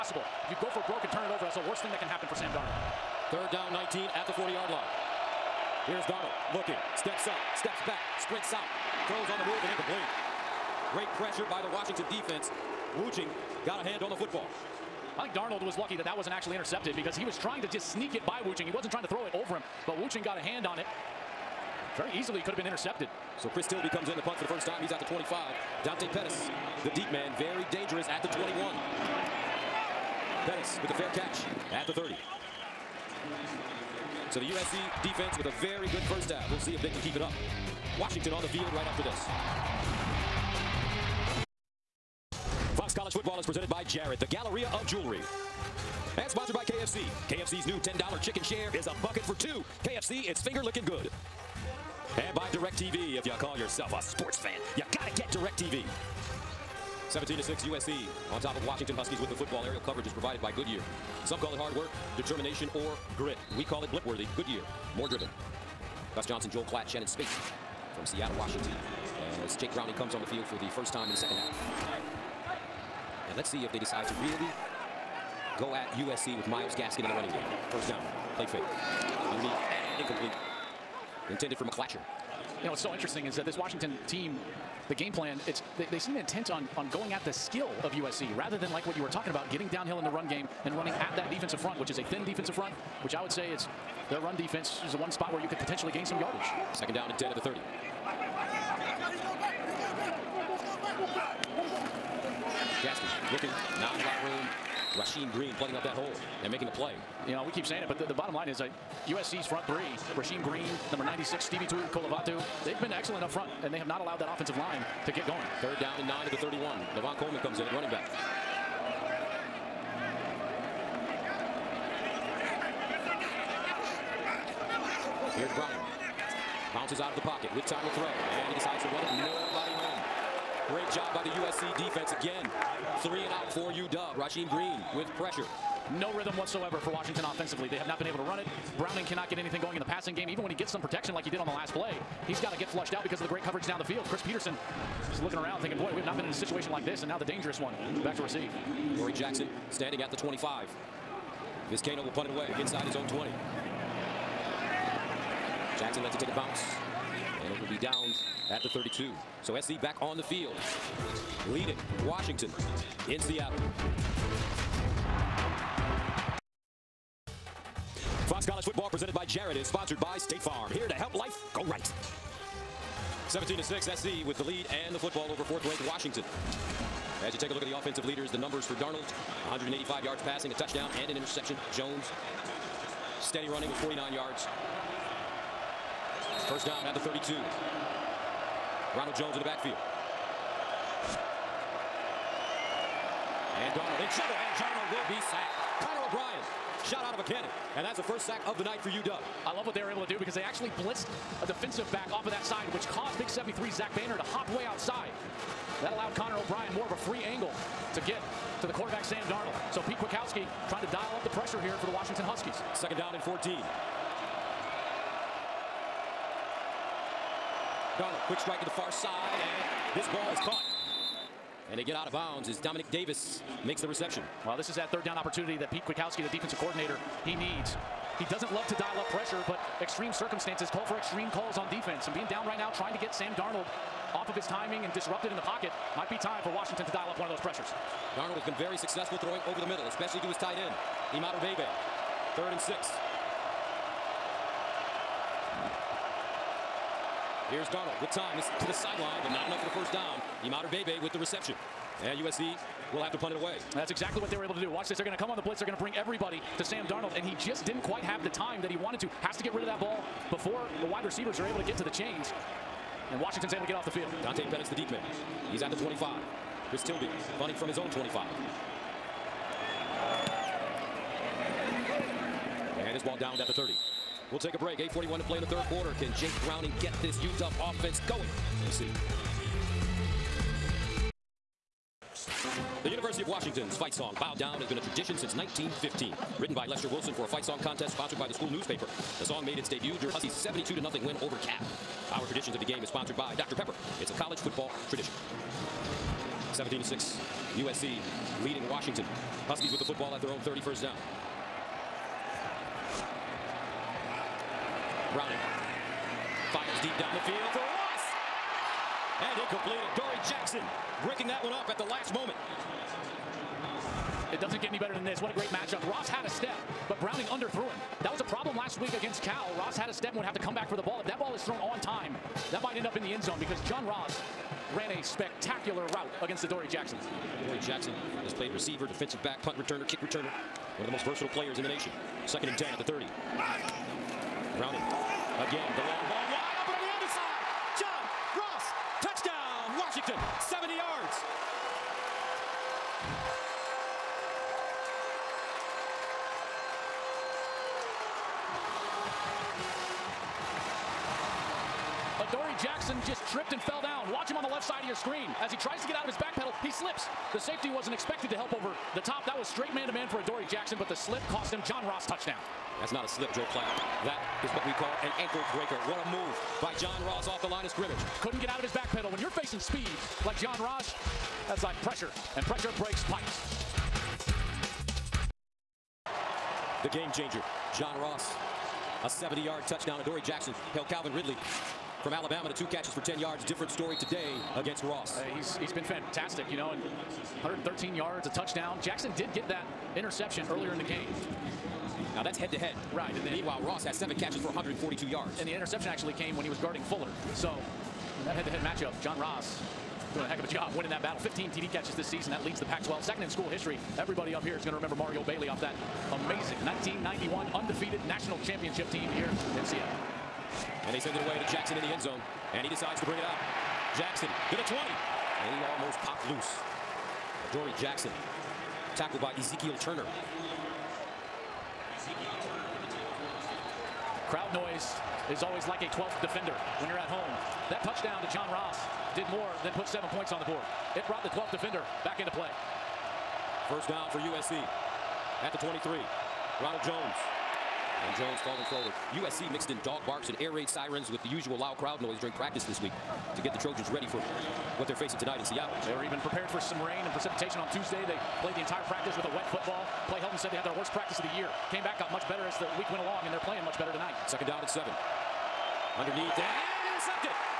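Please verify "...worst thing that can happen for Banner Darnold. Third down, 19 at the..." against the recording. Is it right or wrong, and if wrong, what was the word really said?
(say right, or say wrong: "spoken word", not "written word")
wrong: "Sam", not "Banner".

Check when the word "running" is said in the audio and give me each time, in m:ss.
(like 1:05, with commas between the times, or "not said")
1:17, 1:30, 1:57, 3:03.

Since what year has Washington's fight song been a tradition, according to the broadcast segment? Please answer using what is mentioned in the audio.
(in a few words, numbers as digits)
1915.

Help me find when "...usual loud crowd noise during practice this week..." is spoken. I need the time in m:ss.
7:21.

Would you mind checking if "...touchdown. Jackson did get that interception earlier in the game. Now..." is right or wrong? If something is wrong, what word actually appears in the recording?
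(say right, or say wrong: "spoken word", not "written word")
right.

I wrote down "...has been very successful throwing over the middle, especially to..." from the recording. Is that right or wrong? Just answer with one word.
right.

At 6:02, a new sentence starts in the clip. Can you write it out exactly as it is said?
That's not a slip, Joel Klatt.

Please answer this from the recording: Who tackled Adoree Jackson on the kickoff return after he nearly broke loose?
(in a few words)
Ezekiel Turner.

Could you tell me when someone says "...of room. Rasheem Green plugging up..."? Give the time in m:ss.
1:44.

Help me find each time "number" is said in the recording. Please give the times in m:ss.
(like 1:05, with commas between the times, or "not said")
1:50, 2:58.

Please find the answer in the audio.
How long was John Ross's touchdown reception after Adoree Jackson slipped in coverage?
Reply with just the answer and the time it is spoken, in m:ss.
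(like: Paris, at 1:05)
70 yards, at 6:19.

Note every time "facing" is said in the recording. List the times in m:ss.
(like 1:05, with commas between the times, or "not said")
6:09, 7:24.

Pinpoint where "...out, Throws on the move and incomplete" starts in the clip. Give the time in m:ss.
0:08.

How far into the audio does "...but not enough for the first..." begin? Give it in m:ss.
4:09.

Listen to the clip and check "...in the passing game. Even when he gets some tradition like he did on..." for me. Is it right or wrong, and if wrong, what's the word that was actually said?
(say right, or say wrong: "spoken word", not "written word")
wrong: "protection", not "tradition".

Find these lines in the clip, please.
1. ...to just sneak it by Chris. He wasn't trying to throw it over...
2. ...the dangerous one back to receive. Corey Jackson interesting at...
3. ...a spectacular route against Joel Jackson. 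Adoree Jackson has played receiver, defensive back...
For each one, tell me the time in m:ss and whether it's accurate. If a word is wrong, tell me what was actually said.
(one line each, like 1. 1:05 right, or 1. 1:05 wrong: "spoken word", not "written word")
1. 0:17 wrong: "Wooching", not "Chris"
2. 2:27 wrong: "standing", not "interesting"
3. 5:24 wrong: "Adoree", not "Joel".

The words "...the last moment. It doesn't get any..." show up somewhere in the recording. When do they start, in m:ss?
5:11.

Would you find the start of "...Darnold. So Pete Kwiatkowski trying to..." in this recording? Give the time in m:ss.
3:29.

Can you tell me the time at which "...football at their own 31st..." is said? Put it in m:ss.
4:59.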